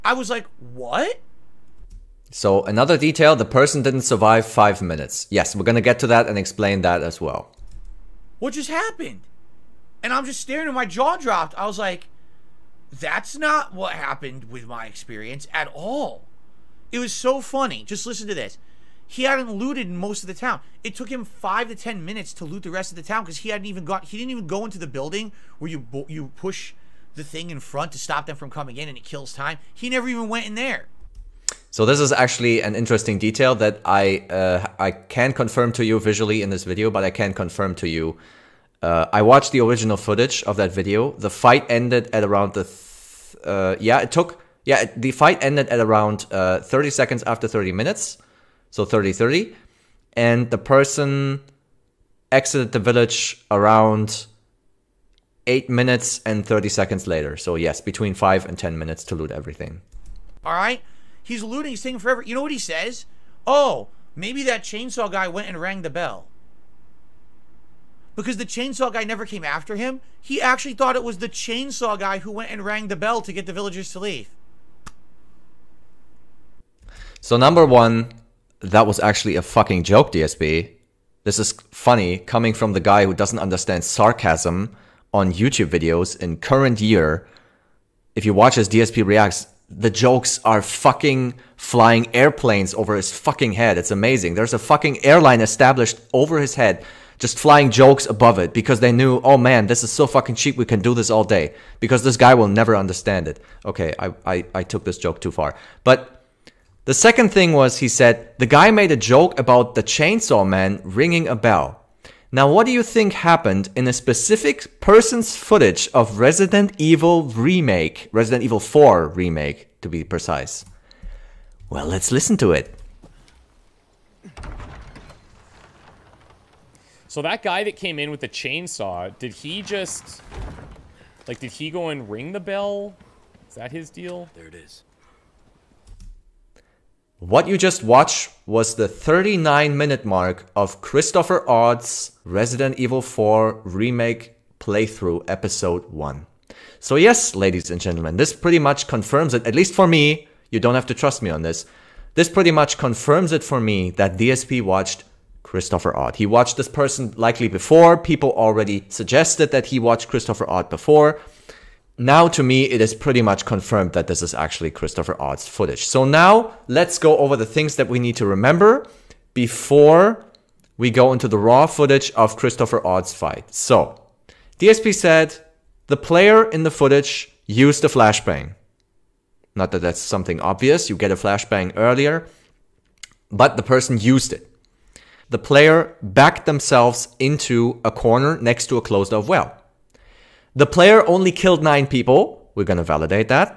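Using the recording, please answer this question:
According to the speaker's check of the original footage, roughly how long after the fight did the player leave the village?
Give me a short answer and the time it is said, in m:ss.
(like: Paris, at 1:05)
8 minutes and 30 seconds, at 0:55.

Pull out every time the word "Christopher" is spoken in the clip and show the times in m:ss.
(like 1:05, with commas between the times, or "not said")
2:20, 2:35, 2:40, 2:44, 2:52.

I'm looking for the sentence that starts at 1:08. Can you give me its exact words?
Because the chainsaw guy never came after him.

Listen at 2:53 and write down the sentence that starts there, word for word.
So DSP said the player in the footage used a flashbang.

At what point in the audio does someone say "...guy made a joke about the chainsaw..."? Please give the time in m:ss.
1:48.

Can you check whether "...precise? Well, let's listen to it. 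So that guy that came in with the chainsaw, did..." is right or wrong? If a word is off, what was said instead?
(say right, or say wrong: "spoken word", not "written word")
right.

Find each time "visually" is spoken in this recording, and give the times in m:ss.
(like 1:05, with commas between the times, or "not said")
0:35.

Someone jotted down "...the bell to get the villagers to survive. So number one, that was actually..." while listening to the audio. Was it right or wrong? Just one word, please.
wrong.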